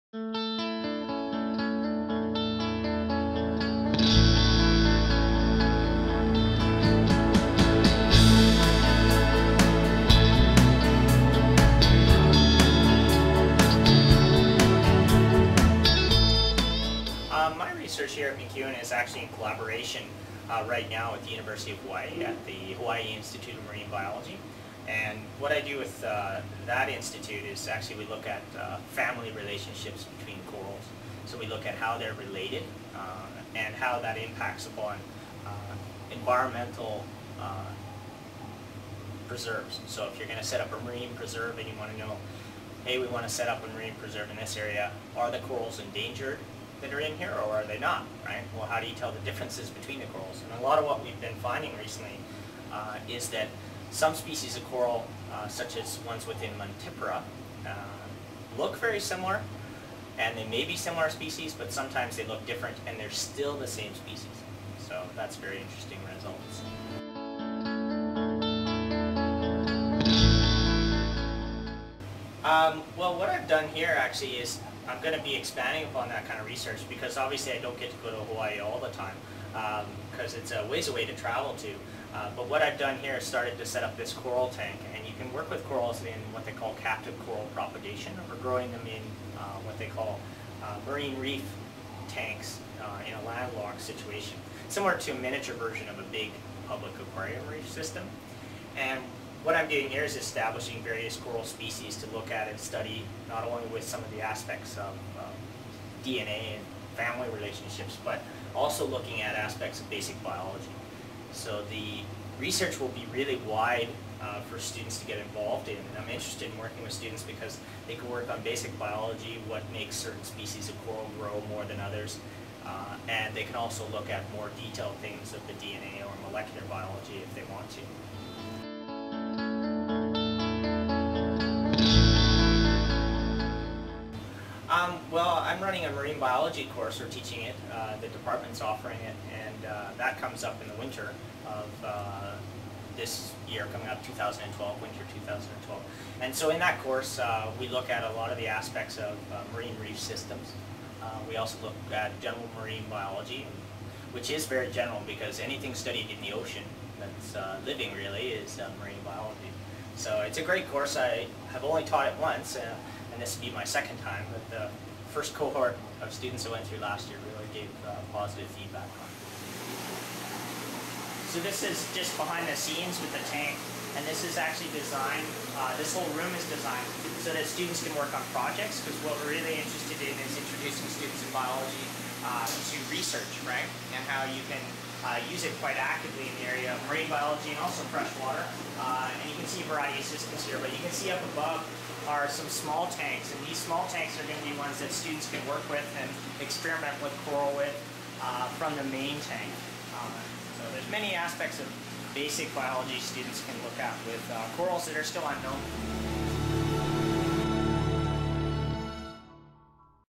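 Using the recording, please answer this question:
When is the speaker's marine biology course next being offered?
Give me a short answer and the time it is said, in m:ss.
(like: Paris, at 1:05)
winter 2012, at 2:24.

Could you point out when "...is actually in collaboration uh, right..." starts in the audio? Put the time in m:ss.
0:18.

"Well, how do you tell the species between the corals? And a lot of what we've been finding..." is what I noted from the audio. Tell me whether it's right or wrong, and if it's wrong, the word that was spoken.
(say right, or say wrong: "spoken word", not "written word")
wrong: "differences", not "species".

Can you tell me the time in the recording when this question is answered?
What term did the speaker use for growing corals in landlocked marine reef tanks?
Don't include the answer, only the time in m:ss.
1:26.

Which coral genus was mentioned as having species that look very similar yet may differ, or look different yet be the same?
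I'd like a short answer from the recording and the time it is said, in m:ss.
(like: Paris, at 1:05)
Montipora, at 0:56.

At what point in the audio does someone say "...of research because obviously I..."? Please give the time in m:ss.
1:16.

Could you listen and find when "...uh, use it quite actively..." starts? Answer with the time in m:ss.
3:05.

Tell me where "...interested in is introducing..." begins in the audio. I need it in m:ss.
2:59.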